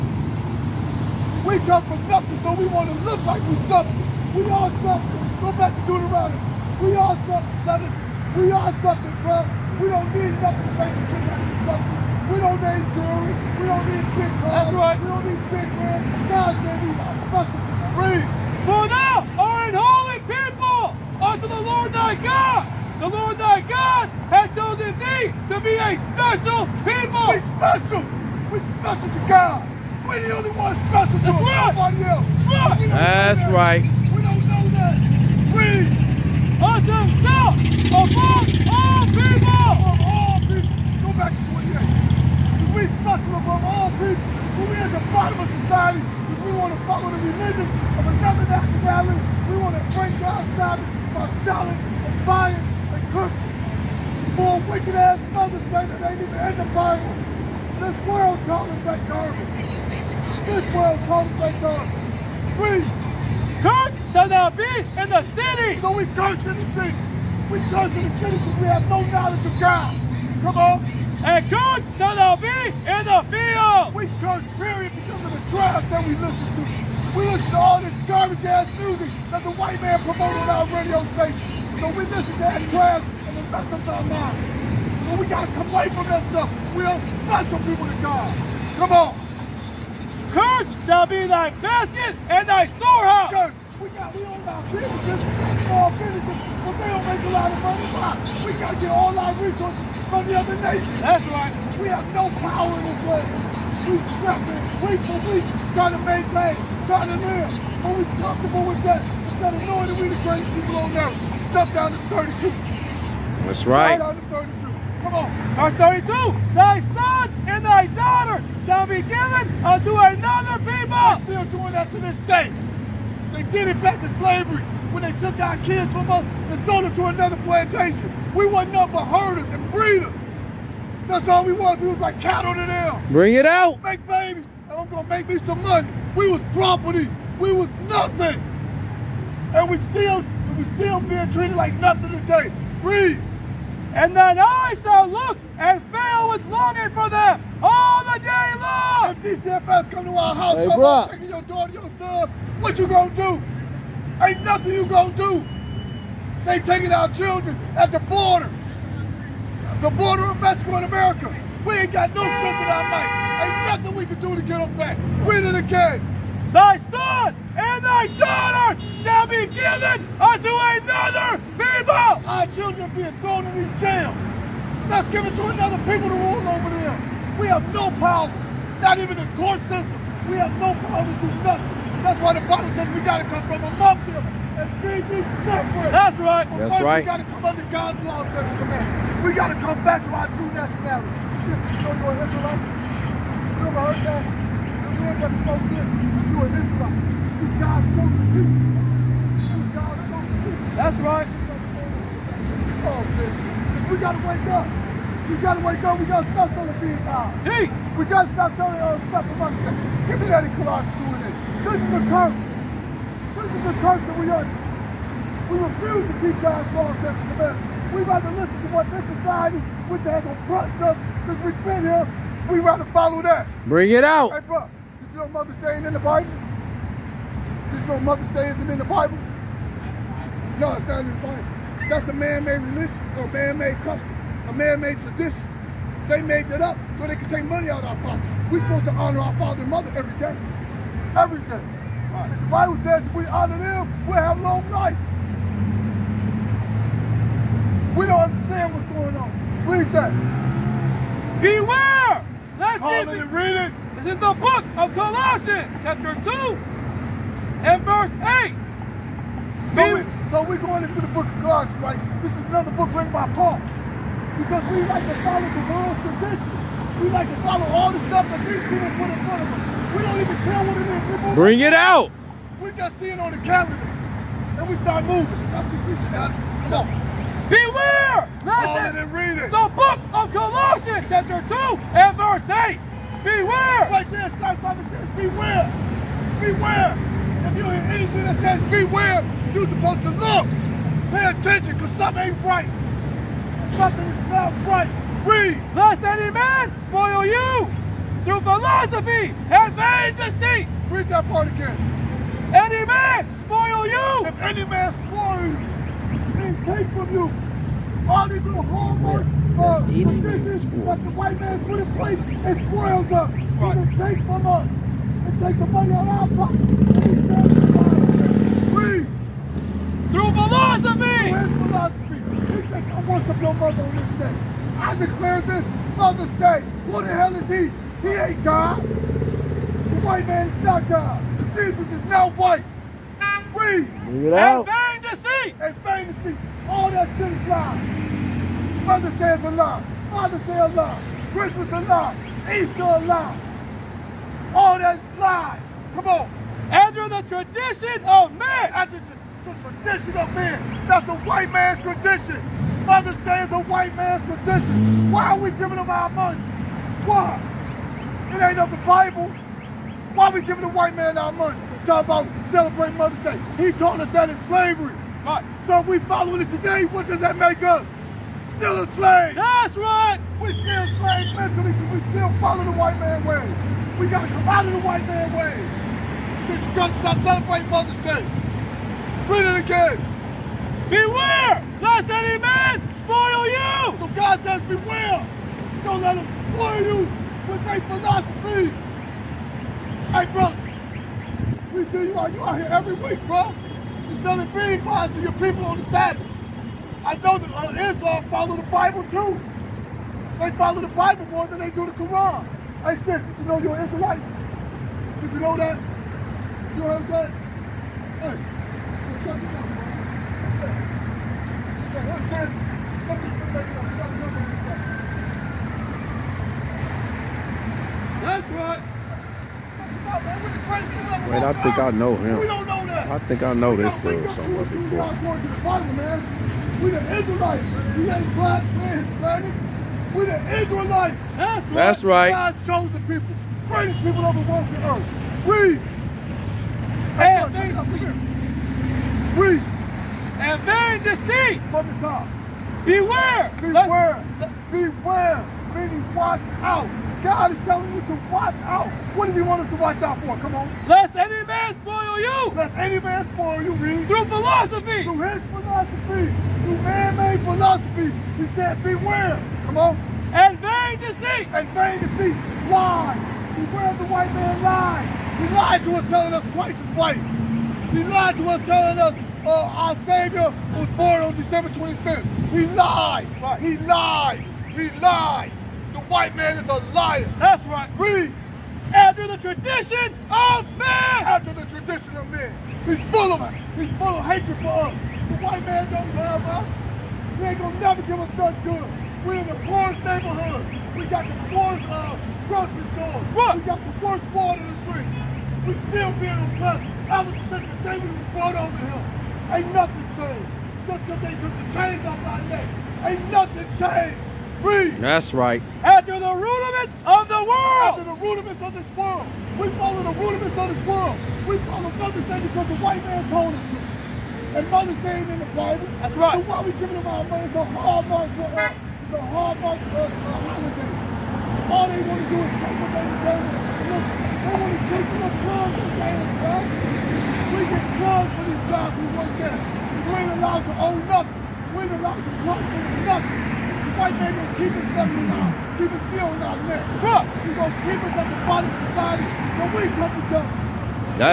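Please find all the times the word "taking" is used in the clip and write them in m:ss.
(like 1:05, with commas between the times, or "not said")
2:31, 2:36.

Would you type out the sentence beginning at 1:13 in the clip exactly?
We curse period because of the trash that we listen to.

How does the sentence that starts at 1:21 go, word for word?
So we miss bad trash and the rest of our minds.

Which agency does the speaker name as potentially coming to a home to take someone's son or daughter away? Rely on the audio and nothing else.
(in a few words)
DCFS.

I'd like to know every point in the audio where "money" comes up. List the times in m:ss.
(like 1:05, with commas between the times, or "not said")
1:37, 2:15, 3:57, 5:15, 5:56, 6:01, 8:37.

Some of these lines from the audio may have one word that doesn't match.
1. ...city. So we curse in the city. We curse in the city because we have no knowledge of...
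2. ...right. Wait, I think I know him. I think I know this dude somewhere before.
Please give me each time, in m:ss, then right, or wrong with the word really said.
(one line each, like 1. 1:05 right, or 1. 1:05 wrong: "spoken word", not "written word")
1. 1:05 right
2. 6:58 right.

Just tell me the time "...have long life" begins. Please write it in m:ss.
4:04.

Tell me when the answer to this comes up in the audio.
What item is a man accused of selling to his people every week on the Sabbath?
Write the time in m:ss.
6:34.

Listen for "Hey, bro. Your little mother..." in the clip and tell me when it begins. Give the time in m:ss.
3:44.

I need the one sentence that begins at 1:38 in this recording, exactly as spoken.
We gotta get all our resources from the other nations.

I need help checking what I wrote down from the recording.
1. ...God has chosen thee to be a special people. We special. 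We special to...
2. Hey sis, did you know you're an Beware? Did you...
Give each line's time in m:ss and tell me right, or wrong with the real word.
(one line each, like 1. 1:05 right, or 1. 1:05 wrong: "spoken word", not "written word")
1. 0:23 right
2. 6:42 wrong: "Israelite", not "Beware".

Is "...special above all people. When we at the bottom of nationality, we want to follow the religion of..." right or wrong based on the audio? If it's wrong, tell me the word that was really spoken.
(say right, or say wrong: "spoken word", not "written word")
wrong: "society", not "nationality".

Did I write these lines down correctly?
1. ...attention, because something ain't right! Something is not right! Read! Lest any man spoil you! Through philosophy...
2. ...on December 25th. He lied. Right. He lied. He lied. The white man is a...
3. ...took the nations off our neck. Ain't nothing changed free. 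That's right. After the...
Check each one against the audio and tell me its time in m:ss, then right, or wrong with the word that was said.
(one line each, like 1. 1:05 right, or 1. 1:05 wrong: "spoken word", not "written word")
1. 4:51 right
2. 7:51 right
3. 8:21 wrong: "chains", not "nations".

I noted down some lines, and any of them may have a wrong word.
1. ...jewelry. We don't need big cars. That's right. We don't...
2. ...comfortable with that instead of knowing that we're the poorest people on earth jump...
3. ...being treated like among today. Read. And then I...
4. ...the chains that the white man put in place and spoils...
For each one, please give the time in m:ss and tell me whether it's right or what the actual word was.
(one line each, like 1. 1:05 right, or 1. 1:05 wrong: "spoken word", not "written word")
1. 0:12 right
2. 1:48 wrong: "greatest", not "poorest"
3. 2:21 wrong: "nothing", not "among"
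4. 5:09 wrong: "traditions", not "chains".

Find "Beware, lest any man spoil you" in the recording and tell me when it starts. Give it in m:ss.
6:20.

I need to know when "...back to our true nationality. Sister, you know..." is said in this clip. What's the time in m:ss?
3:09.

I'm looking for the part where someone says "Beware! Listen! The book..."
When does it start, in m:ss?
4:37.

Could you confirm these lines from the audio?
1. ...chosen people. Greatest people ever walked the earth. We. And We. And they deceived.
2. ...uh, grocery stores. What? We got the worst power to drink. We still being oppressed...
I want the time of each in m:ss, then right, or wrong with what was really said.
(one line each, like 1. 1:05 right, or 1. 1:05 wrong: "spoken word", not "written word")
1. 7:12 right
2. 8:11 wrong: "water", not "power".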